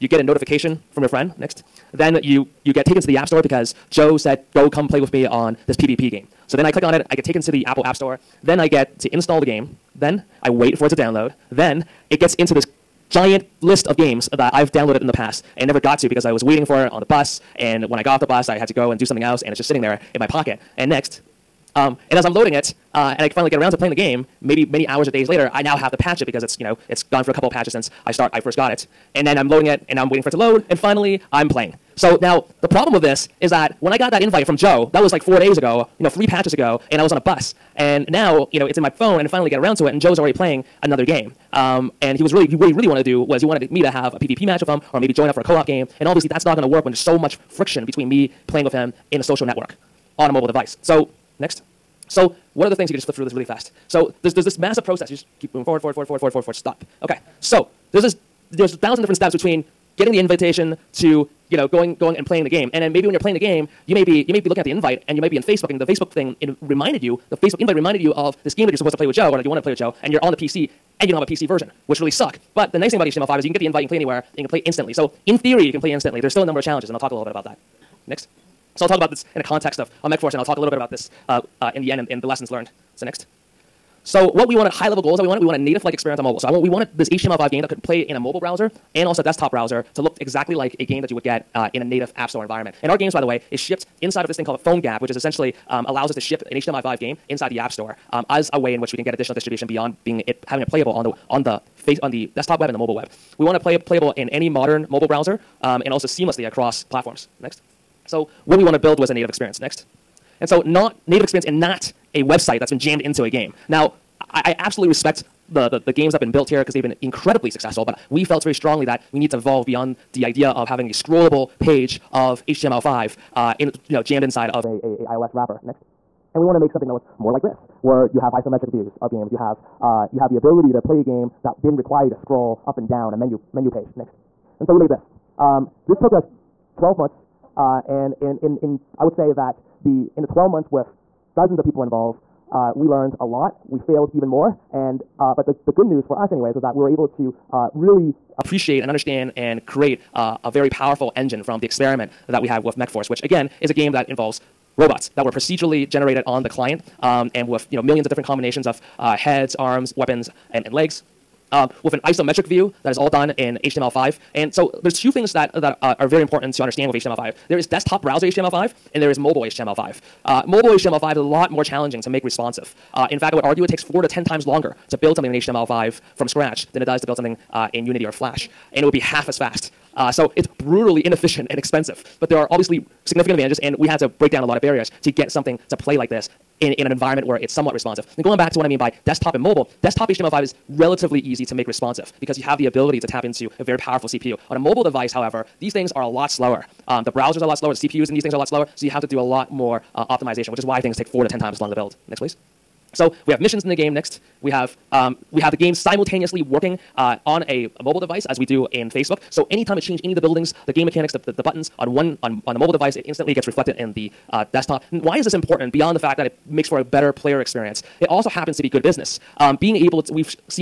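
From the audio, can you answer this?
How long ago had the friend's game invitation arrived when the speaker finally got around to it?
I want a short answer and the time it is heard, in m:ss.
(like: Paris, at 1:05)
4 days ago, at 0:35.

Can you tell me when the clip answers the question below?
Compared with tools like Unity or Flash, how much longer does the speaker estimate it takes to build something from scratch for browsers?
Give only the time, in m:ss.
2:53.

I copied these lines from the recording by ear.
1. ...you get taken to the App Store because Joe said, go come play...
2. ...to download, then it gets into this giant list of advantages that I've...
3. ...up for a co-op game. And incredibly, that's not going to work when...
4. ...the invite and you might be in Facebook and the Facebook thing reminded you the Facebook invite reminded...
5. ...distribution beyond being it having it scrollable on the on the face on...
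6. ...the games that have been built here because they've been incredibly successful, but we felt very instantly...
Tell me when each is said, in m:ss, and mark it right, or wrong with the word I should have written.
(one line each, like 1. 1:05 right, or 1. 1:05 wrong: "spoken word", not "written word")
1. 0:02 right
2. 0:10 wrong: "games", not "advantages"
3. 0:45 wrong: "obviously", not "incredibly"
4. 1:04 right
5. 1:39 wrong: "playable", not "scrollable"
6. 1:55 wrong: "strongly", not "instantly".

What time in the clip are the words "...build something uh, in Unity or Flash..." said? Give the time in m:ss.
2:57.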